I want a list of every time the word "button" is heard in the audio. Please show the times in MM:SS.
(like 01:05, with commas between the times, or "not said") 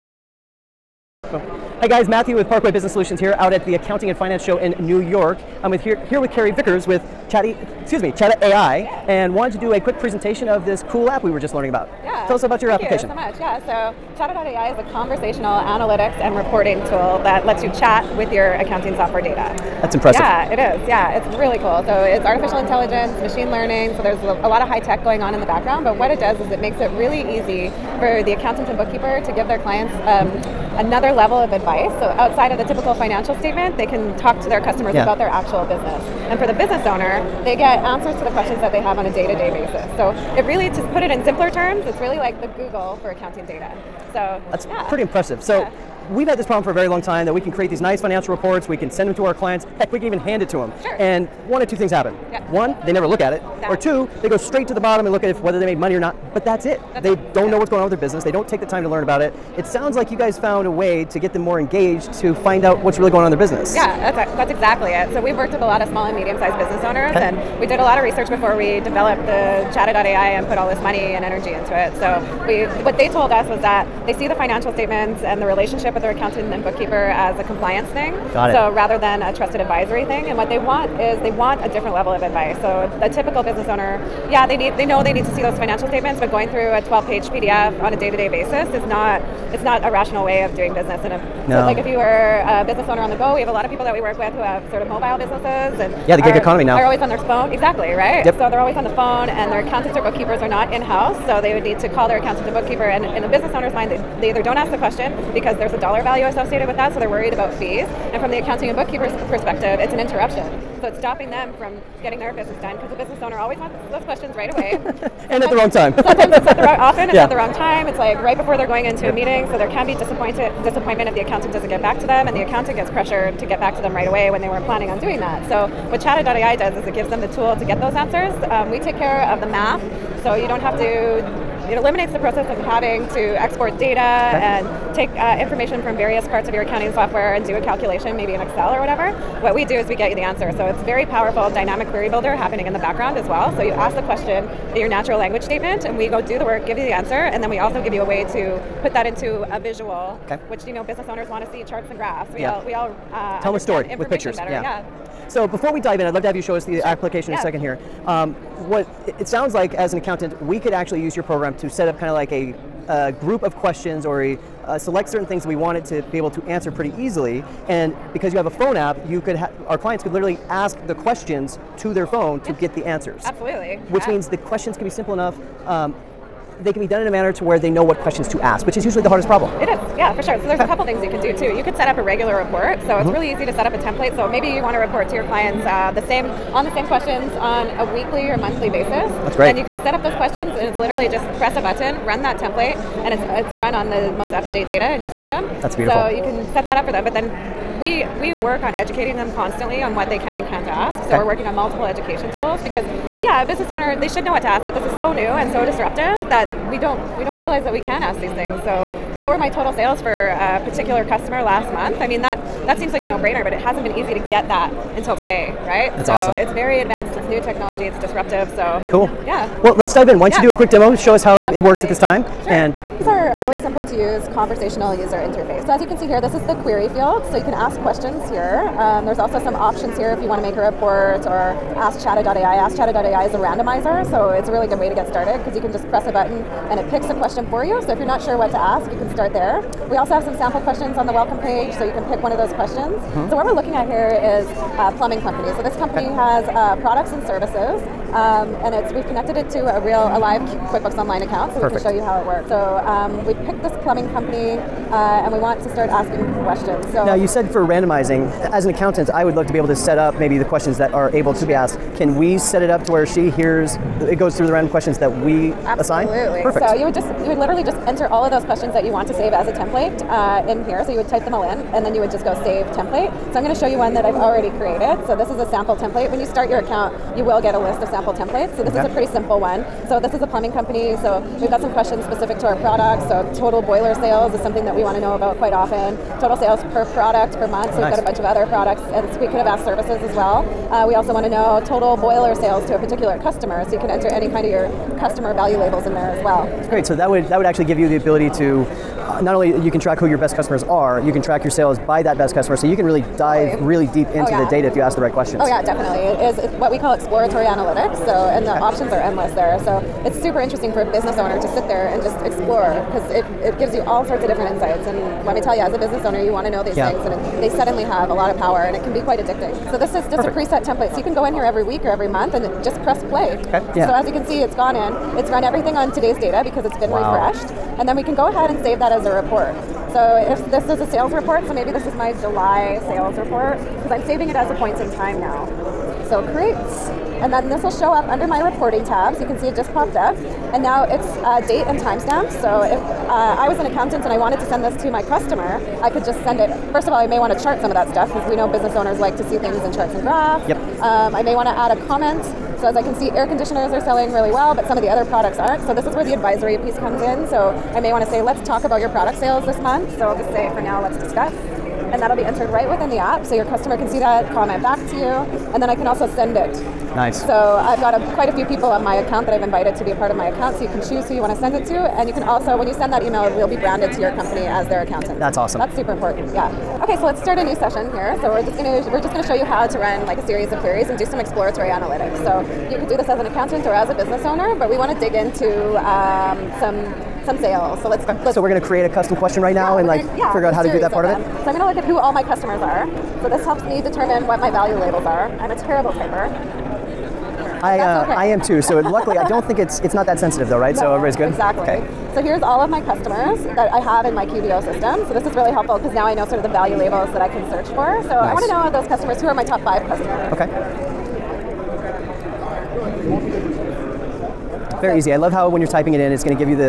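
03:11, 03:56.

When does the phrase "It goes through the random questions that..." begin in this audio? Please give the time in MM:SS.
04:24.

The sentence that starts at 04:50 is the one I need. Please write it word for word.
Uh, we also want to know total boiler sales to a particular customer.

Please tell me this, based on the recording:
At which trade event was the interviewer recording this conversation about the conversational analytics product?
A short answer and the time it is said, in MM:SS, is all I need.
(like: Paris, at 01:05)
Accounting and Finance Show, at 00:03.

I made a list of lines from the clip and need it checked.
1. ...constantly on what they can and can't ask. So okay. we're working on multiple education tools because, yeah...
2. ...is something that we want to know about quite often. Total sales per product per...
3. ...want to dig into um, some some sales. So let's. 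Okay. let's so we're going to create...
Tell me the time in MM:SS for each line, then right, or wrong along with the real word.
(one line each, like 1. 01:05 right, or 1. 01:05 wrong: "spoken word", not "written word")
1. 03:19 right
2. 04:44 right
3. 06:24 right.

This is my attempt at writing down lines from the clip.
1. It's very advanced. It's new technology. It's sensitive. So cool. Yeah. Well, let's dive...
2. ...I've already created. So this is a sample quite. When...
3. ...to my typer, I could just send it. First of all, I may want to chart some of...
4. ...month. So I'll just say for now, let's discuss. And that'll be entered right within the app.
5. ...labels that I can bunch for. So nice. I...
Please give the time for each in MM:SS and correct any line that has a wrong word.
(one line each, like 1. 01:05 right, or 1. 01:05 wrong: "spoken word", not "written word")
1. 03:36 wrong: "disruptive", not "sensitive"
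2. 04:34 wrong: "template", not "quite"
3. 05:44 wrong: "customer", not "typer"
4. 05:59 right
5. 06:46 wrong: "search", not "bunch".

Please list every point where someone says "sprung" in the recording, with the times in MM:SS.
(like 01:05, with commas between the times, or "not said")
not said.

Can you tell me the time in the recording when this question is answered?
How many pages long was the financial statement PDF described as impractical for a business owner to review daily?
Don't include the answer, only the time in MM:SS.
01:26.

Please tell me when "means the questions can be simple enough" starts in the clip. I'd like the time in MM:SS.
02:54.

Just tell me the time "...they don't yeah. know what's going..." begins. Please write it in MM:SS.
00:57.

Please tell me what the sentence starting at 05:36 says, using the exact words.
So create and then this will show up under my reporting tabs.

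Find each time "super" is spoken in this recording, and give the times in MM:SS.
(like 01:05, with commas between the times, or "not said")
05:10, 06:15.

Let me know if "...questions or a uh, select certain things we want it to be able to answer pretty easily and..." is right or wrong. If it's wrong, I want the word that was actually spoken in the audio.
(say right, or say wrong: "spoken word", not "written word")
right.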